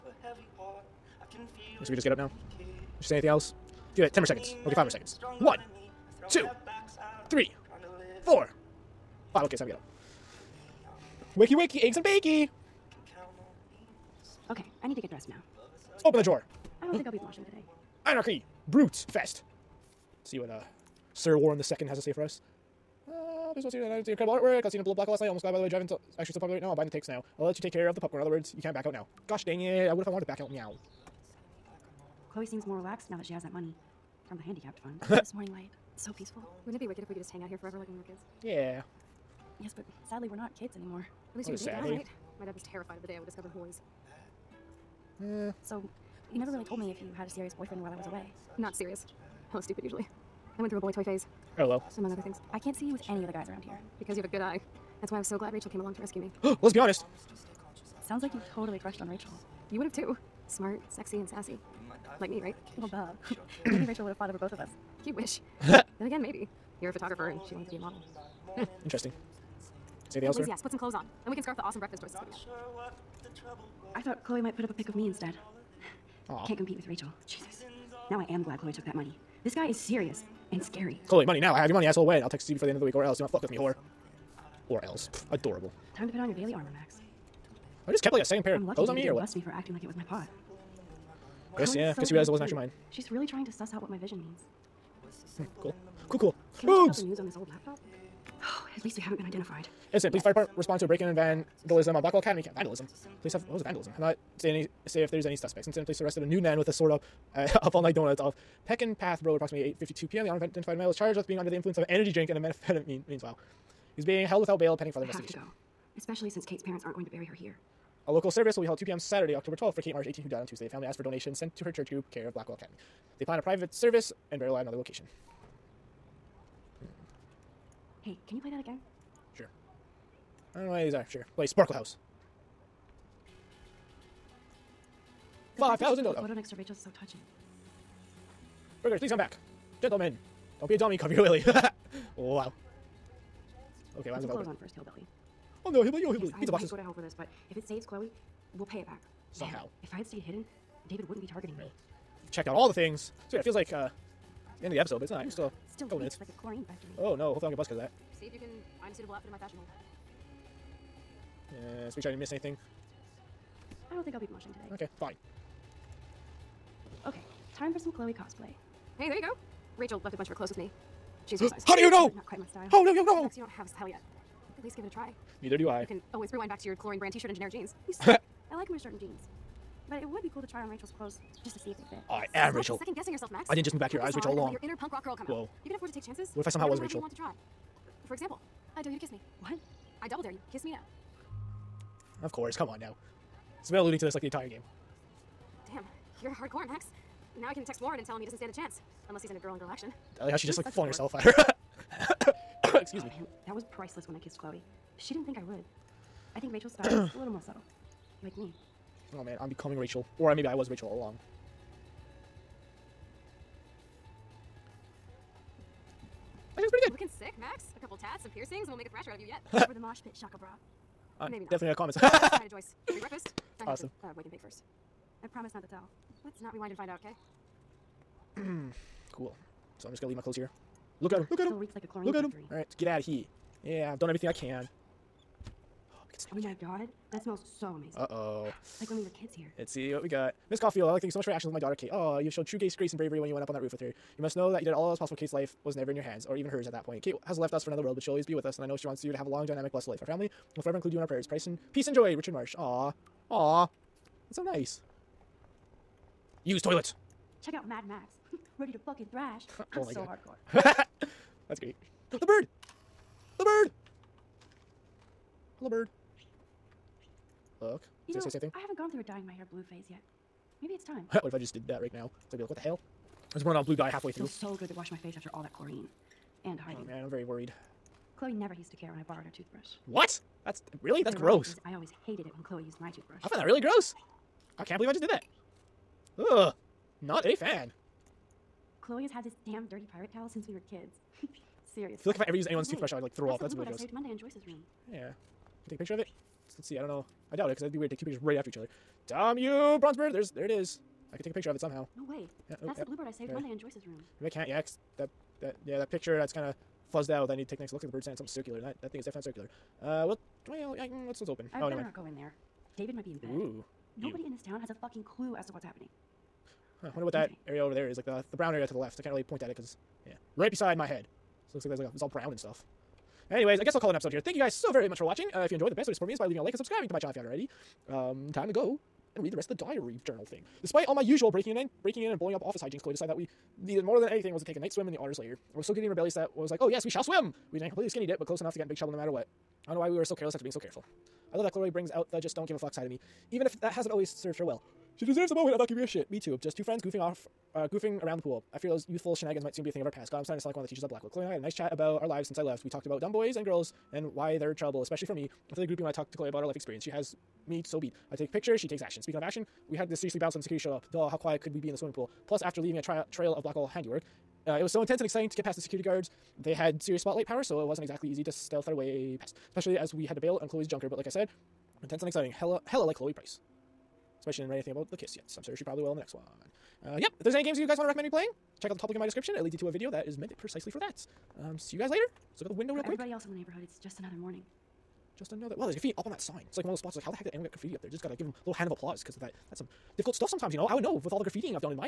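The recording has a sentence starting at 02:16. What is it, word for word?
photo next to Rachel's so touching.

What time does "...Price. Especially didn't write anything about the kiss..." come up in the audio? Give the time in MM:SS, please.
06:13.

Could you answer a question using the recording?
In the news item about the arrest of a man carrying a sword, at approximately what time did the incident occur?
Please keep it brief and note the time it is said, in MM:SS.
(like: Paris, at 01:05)
8:52 p.m., at 01:49.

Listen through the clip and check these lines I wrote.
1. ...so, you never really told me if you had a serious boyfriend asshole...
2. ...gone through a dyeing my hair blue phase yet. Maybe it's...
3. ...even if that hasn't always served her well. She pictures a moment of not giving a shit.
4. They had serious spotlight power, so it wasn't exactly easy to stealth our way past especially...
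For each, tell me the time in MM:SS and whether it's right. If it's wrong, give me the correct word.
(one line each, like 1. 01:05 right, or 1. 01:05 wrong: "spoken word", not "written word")
1. 00:45 wrong: "while", not "asshole"
2. 04:28 right
3. 05:43 wrong: "deserves", not "pictures"
4. 06:06 right.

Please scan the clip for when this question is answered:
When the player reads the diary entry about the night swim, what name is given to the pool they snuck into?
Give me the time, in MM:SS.
05:34.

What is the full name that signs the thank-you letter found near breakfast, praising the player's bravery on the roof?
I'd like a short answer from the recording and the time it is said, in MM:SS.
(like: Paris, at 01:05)
Richard Marsh, at 04:12.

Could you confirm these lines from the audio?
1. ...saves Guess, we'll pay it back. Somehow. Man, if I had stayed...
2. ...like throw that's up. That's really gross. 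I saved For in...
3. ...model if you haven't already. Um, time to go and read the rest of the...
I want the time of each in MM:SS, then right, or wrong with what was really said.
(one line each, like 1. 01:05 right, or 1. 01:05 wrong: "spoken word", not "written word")
1. 02:27 wrong: "Chloe", not "Guess"
2. 04:53 wrong: "Monday", not "For"
3. 05:26 wrong: "channel", not "model".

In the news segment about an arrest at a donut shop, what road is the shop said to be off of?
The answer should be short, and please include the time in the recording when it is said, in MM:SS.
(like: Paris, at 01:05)
Pekin Path Road, at 01:48.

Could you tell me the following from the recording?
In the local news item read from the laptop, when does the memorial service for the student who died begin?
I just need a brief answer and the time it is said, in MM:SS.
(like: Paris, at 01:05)
2 p.m., at 01:58.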